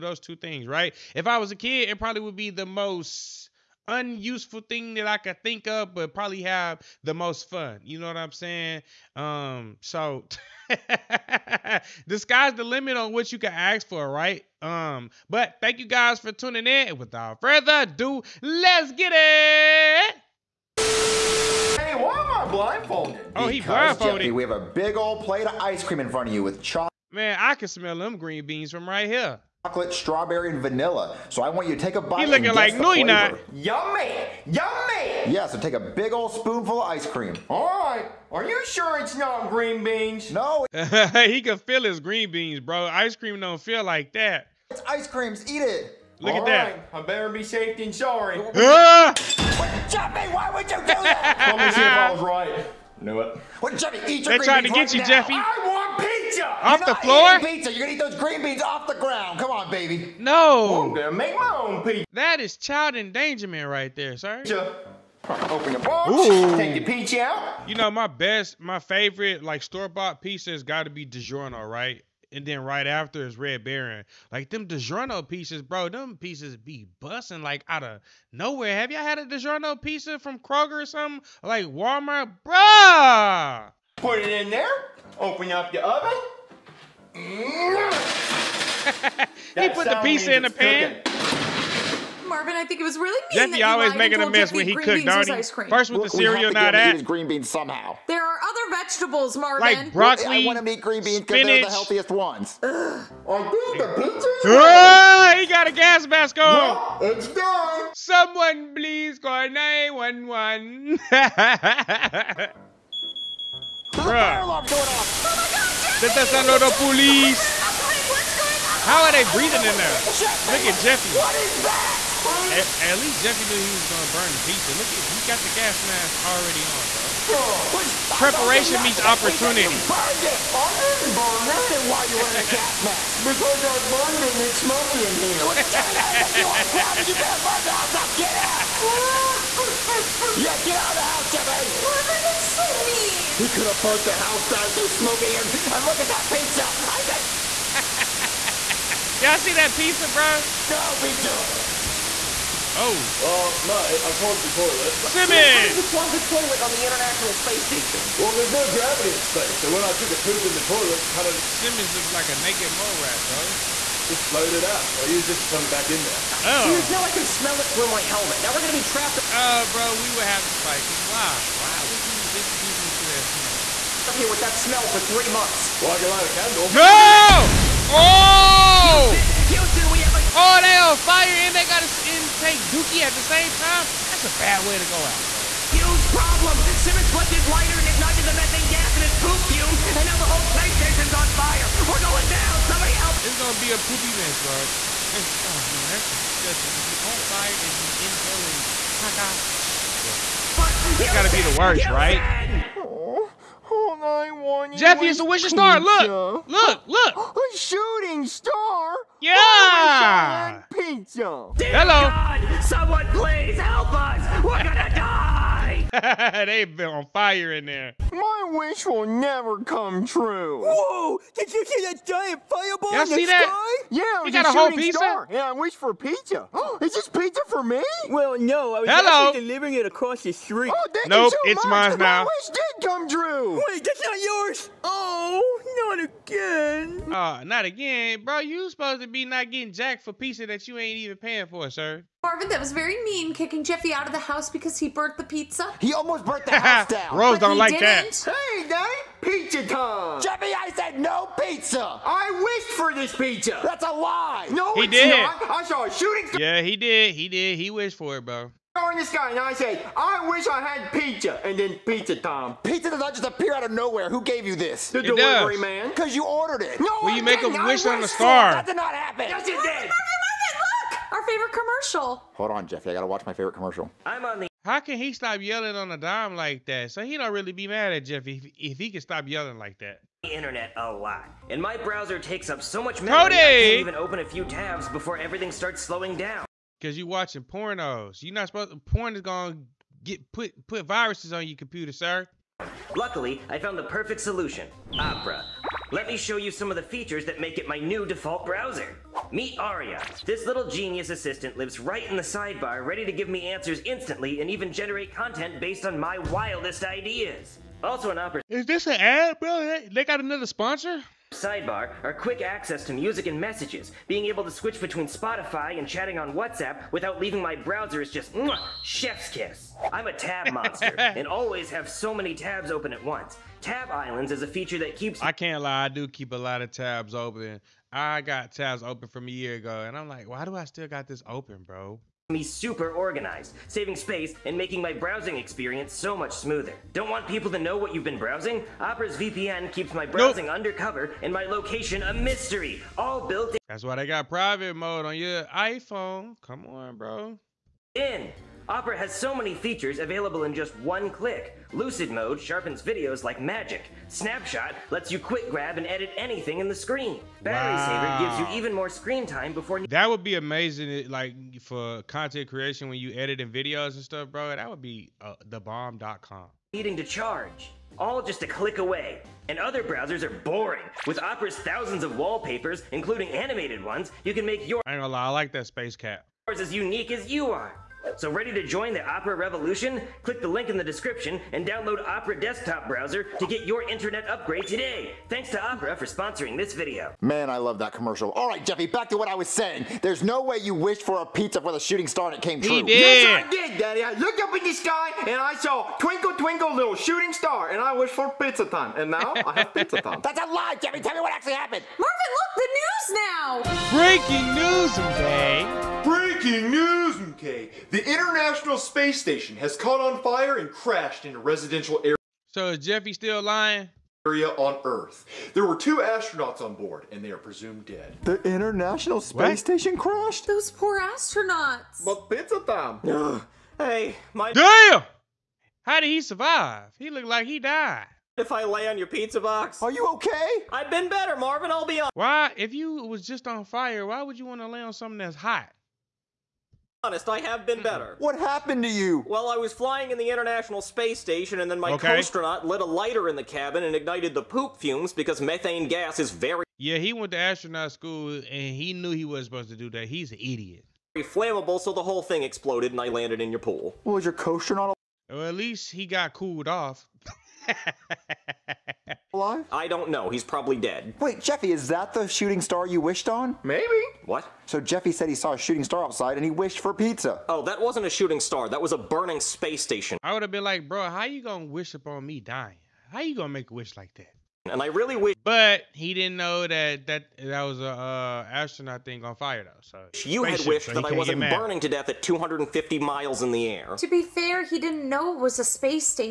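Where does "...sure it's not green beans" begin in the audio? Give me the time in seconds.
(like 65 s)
38 s.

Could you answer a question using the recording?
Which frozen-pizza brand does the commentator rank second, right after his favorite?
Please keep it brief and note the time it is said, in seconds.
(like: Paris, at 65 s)
Red Baron, at 73 s.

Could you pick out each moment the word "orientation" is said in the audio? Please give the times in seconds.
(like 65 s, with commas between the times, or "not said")
not said.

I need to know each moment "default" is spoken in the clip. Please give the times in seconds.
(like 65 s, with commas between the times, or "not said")
298 s.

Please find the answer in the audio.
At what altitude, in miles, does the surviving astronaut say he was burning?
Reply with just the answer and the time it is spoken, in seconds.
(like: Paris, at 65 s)
250 miles, at 482 s.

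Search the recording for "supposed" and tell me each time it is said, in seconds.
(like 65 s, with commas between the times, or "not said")
238 s, 288 s, 449 s.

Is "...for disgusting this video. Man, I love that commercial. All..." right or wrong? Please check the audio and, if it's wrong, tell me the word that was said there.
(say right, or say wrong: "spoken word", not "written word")
wrong: "sponsoring", not "disgusting".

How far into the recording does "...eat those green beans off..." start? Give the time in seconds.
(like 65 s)
57 s.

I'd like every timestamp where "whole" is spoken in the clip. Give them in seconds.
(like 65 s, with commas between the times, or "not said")
190 s, 224 s, 452 s.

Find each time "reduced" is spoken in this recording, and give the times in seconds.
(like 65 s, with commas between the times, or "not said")
not said.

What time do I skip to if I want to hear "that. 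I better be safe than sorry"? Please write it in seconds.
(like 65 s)
46 s.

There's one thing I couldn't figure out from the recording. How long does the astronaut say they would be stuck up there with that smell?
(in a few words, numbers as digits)
Three months.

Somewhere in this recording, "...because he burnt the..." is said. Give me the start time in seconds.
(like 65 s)
244 s.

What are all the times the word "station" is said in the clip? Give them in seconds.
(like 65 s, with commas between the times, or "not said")
157 s, 190 s, 409 s, 419 s, 441 s, 469 s.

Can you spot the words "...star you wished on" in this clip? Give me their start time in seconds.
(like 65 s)
462 s.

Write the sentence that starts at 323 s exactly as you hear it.
Tab Islands is a feature that keeps.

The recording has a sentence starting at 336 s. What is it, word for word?
Don't want people to know what you've been browsing?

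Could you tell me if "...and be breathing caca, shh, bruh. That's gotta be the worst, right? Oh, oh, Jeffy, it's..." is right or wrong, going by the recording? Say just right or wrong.
wrong.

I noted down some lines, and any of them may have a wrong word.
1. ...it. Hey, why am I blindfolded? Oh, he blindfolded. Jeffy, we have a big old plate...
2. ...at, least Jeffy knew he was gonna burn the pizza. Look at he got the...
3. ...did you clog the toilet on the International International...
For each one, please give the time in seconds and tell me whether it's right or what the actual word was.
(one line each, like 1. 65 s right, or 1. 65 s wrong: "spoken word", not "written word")
1. 19 s right
2. 122 s right
3. 155 s wrong: "Space", not "International".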